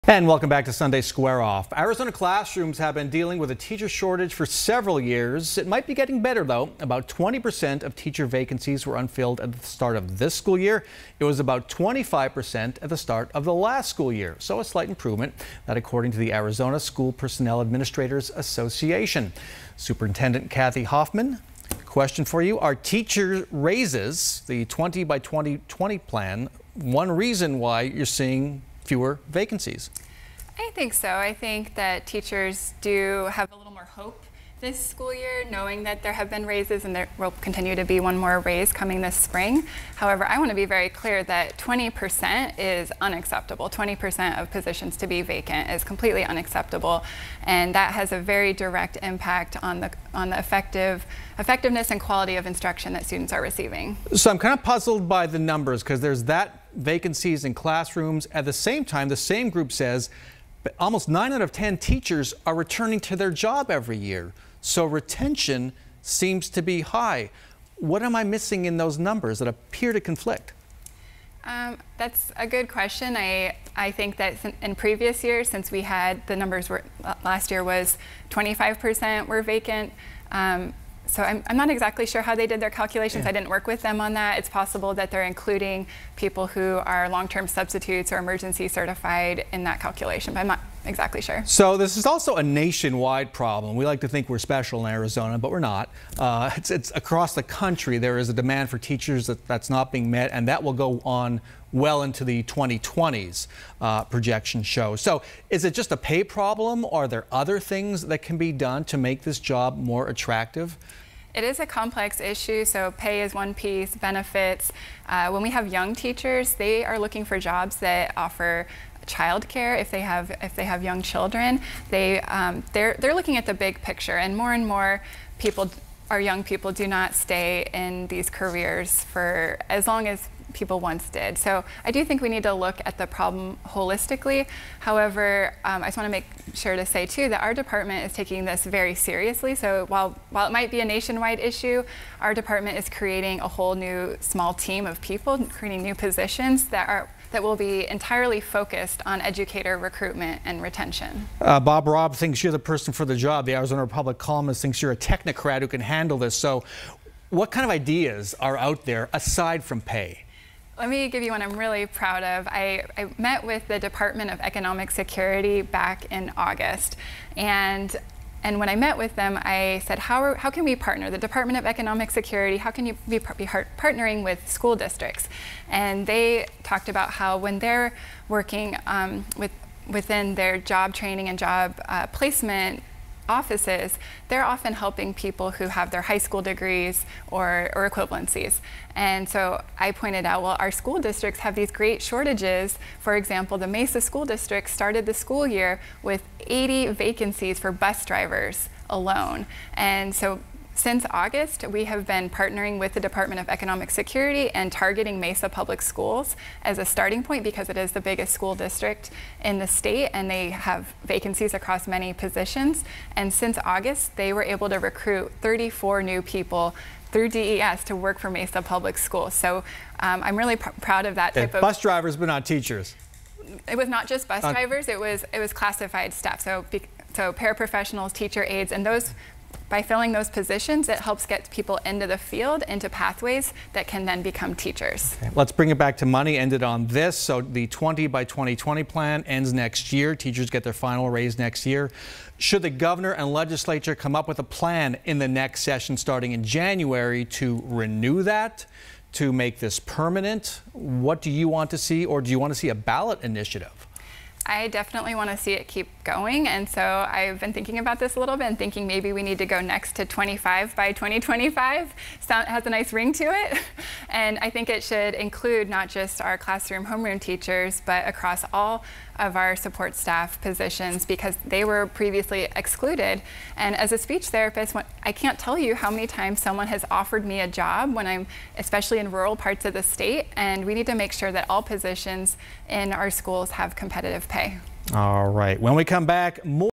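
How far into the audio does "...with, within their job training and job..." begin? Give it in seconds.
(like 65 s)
179 s.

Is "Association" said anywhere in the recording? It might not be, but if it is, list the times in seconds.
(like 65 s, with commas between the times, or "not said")
18 s.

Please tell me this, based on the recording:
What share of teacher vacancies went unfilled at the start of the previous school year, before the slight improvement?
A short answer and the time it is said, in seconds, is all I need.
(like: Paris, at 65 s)
25%, at 11 s.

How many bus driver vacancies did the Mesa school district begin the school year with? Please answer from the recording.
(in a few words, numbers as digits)
80.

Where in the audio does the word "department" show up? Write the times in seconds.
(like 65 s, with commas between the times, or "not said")
137 s, 142 s, 163 s, 171 s, 202 s.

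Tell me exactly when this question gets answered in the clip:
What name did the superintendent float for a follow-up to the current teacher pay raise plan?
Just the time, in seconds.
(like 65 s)
260 s.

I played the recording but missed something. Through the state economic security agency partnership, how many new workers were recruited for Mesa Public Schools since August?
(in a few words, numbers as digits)
34.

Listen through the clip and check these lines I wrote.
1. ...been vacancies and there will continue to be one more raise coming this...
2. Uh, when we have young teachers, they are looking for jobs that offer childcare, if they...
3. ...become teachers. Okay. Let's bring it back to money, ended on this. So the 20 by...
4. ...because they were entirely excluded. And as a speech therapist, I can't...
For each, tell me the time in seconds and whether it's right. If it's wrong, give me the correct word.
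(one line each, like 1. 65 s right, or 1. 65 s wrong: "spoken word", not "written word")
1. 36 s wrong: "raises", not "vacancies"
2. 115 s right
3. 234 s right
4. 271 s wrong: "previously", not "entirely".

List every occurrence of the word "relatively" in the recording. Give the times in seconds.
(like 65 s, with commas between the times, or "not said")
not said.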